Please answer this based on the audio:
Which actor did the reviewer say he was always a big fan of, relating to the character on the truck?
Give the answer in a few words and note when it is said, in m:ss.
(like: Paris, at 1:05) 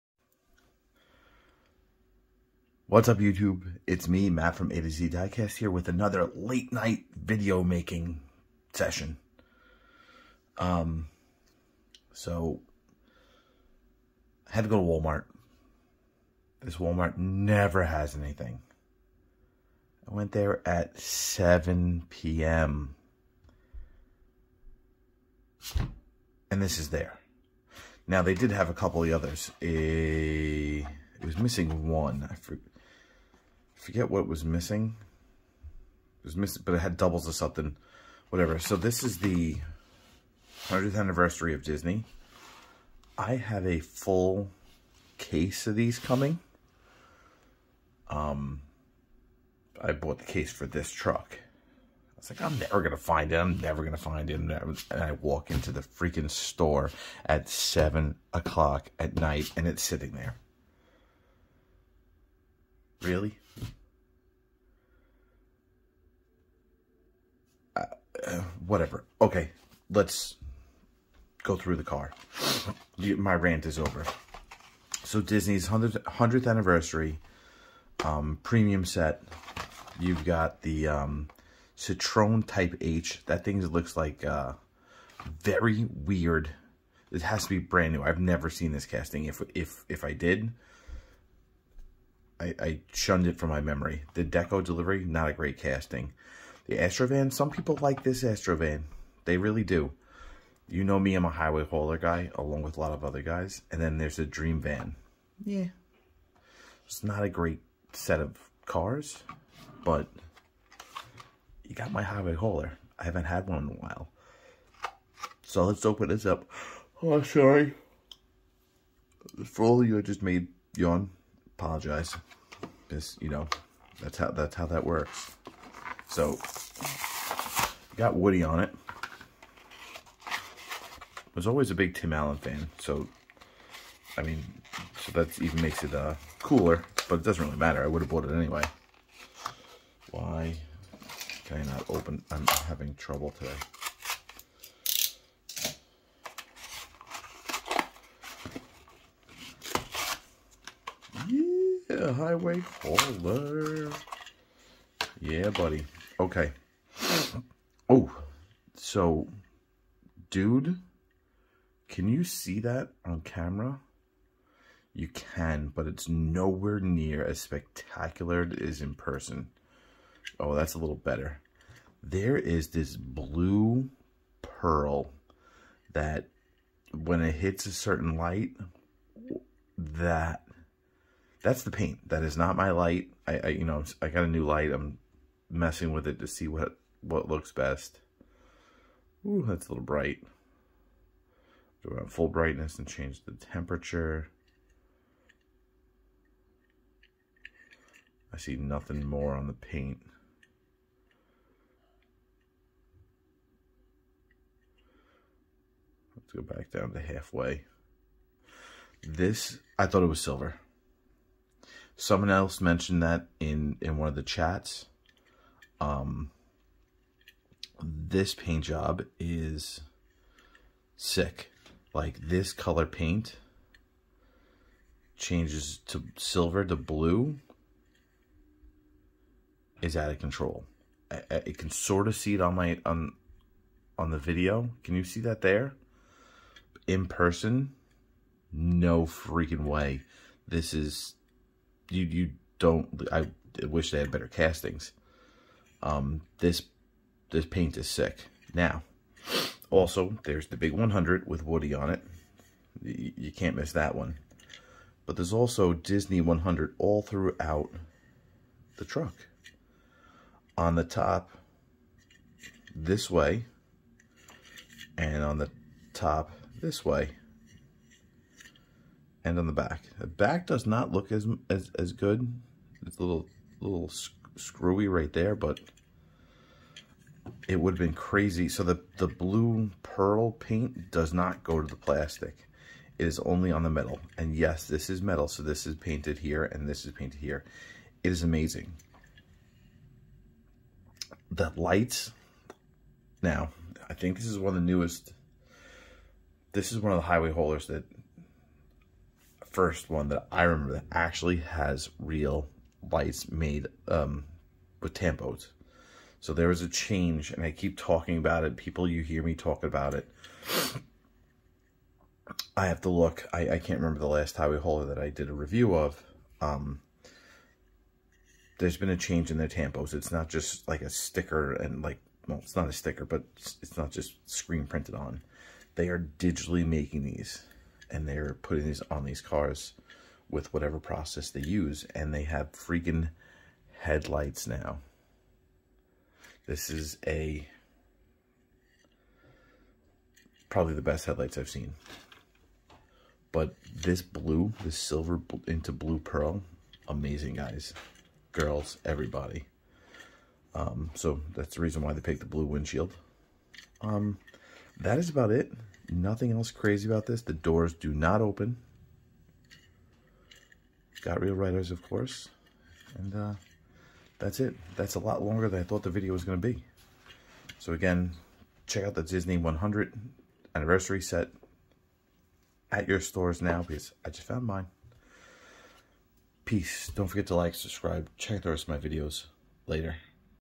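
Tim Allen, at 2:11.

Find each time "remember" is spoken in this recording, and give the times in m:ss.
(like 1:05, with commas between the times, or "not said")
5:00, 5:13.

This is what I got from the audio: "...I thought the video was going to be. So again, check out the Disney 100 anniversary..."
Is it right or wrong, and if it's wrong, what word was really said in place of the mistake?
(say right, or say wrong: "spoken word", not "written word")
right.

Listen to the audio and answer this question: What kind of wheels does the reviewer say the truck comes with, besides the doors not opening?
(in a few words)
Real Riders.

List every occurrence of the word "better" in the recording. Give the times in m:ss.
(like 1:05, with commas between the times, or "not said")
2:50, 4:04.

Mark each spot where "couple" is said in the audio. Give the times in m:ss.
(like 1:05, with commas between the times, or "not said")
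0:28.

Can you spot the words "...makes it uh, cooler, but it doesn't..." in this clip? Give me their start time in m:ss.
2:15.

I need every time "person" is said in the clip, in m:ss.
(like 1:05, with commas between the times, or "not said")
2:48, 3:57.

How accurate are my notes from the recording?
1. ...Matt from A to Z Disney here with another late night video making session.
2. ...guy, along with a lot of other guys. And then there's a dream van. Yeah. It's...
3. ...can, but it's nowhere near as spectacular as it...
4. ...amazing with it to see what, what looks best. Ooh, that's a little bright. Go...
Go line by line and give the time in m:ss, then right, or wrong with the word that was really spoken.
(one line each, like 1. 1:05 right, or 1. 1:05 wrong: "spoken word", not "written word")
1. 0:04 wrong: "Diecast", not "Disney"
2. 1:41 right
3. 2:45 right
4. 3:05 wrong: "messing", not "amazing".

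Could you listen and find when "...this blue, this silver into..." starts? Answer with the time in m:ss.
5:43.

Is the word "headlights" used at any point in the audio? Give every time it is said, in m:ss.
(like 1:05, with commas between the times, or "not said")
5:33, 5:41.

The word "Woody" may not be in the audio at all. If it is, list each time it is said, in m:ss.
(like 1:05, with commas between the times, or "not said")
2:08, 4:11.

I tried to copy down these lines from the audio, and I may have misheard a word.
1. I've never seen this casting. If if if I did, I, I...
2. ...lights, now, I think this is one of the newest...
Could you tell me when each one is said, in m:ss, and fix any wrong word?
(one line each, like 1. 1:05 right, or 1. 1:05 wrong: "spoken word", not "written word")
1. 1:28 right
2. 4:51 right.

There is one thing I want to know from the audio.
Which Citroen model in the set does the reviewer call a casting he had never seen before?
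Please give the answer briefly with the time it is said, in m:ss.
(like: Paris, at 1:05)
Type H, at 1:22.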